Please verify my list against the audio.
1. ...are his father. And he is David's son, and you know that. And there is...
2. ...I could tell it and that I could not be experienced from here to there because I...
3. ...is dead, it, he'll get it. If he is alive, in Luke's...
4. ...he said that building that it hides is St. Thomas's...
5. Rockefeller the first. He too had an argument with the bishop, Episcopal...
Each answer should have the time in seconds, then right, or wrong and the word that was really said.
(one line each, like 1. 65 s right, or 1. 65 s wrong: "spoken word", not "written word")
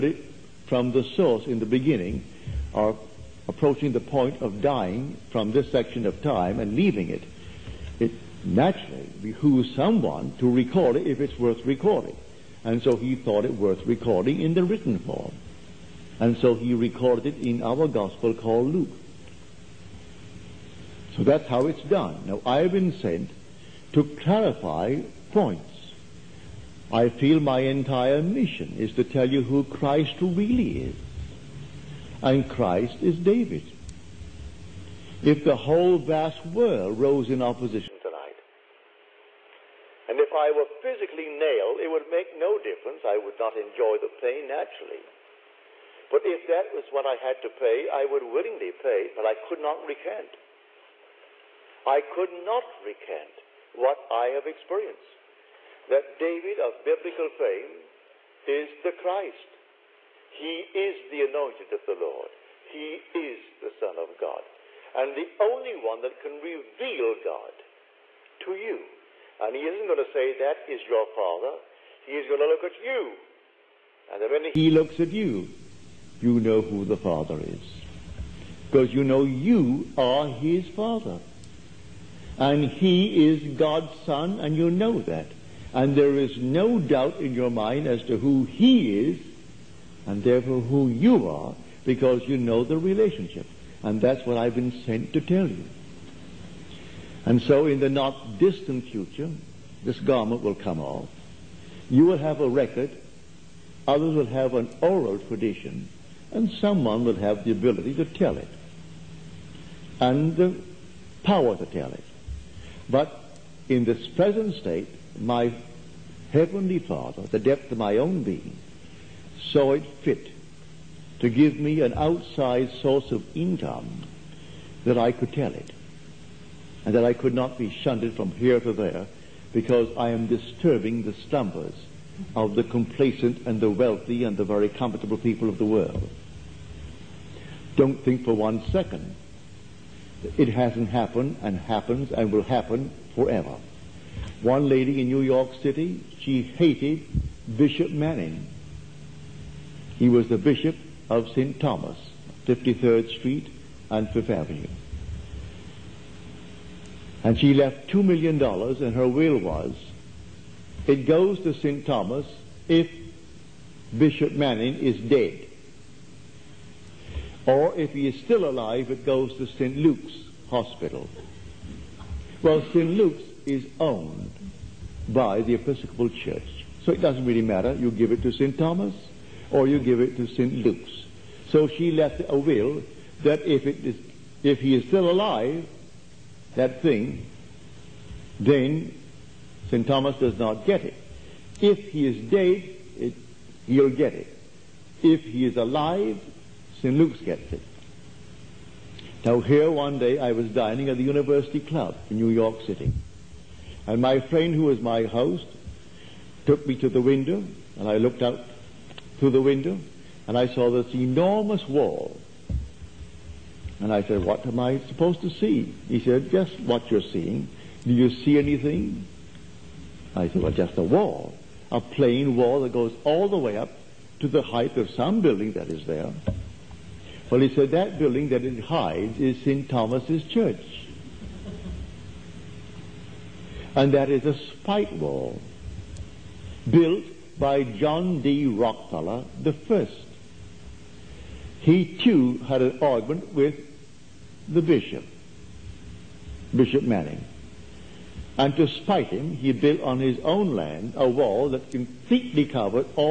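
1. 79 s wrong: "God", not "David"
2. 124 s wrong: "shunted", not "experienced"
3. 192 s right
4. 227 s right
5. 238 s wrong: "Bishop", not "Episcopal".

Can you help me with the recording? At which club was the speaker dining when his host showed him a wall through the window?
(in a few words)
University Club.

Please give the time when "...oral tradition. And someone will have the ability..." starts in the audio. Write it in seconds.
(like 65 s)
104 s.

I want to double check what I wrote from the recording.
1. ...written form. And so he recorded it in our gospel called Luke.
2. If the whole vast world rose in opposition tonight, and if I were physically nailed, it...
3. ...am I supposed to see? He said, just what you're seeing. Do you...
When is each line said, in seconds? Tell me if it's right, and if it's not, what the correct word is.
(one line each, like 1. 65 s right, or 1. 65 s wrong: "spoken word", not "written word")
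1. 14 s right
2. 35 s right
3. 214 s right.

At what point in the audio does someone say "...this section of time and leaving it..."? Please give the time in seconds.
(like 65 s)
5 s.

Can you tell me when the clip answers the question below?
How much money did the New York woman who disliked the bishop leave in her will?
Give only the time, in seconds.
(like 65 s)
157 s.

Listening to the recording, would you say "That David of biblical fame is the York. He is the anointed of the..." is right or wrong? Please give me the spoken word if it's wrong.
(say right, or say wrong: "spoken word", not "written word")
wrong: "Christ", not "York".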